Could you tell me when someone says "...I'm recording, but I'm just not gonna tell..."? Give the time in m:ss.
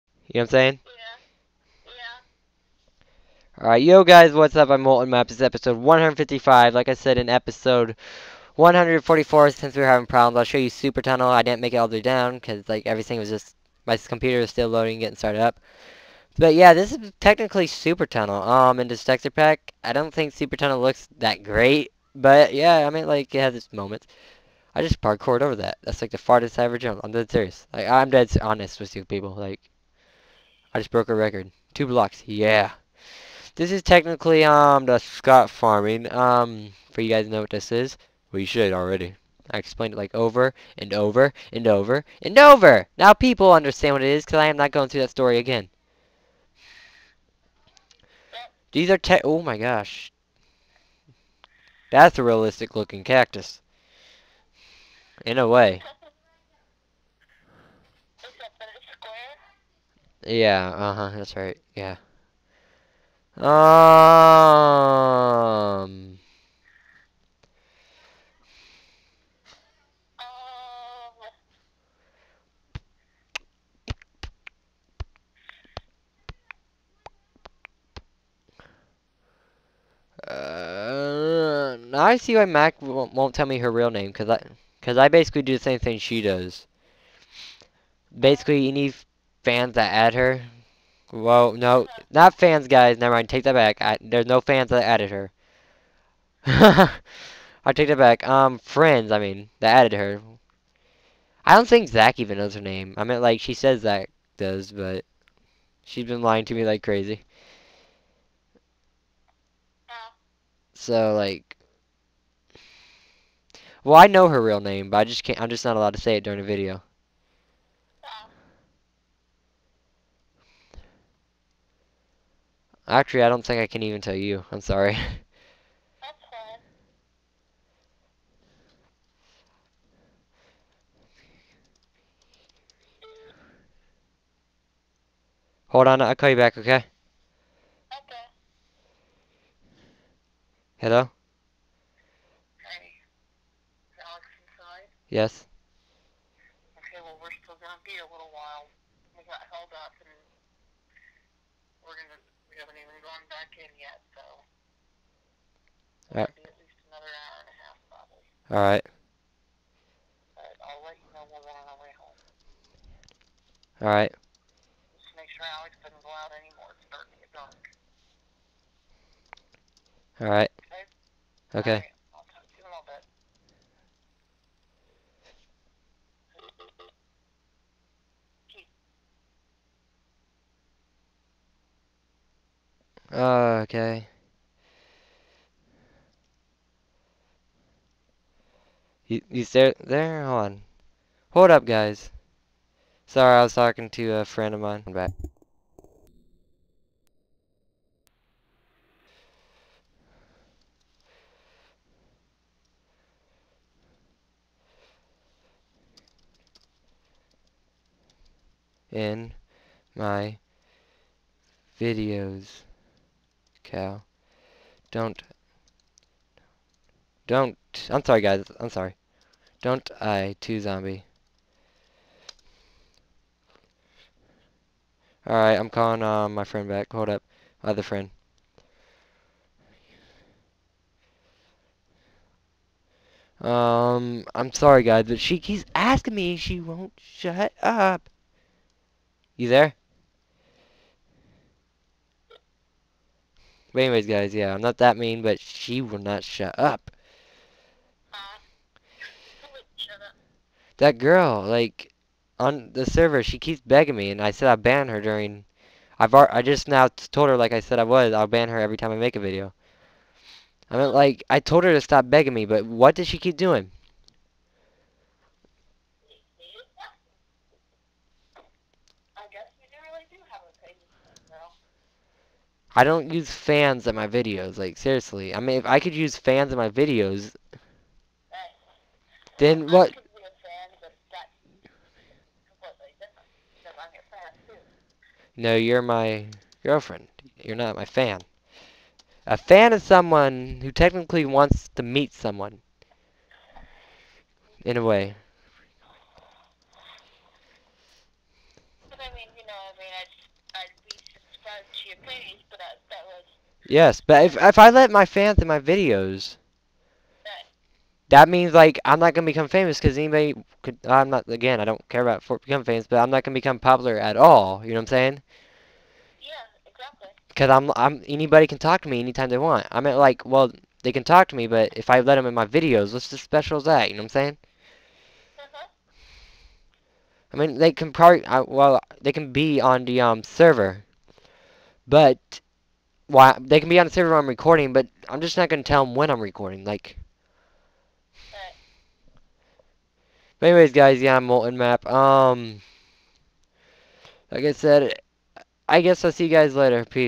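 5:34.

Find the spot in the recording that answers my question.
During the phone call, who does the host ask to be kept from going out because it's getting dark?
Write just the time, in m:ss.
2:45.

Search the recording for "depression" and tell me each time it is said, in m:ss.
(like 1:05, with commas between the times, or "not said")
not said.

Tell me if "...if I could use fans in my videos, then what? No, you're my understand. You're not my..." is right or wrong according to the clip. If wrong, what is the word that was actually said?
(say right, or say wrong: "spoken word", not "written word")
wrong: "girlfriend", not "understand".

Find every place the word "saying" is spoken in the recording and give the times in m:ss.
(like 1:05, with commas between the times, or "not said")
0:00, 5:14, 5:24.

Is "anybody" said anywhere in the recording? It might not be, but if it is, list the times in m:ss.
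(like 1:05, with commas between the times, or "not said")
5:09, 5:18.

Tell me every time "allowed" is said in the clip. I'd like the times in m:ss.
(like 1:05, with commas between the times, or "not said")
1:55.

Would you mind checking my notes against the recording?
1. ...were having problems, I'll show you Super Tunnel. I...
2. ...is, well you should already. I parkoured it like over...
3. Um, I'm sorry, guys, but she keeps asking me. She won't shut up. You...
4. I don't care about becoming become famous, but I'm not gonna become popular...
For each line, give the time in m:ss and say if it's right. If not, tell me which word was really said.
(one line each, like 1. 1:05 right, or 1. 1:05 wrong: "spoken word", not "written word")
1. 0:09 right
2. 0:37 wrong: "explained", not "parkoured"
3. 3:53 right
4. 5:11 right.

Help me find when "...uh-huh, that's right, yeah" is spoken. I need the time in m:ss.
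1:00.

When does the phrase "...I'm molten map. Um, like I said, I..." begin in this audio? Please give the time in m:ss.
5:41.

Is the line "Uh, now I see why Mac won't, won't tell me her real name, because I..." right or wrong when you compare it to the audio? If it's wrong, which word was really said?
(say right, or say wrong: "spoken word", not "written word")
right.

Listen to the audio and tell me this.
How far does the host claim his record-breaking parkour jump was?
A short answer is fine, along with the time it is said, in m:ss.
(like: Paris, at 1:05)
Two blocks, at 0:31.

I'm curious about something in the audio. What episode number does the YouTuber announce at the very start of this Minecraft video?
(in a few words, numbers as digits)
155.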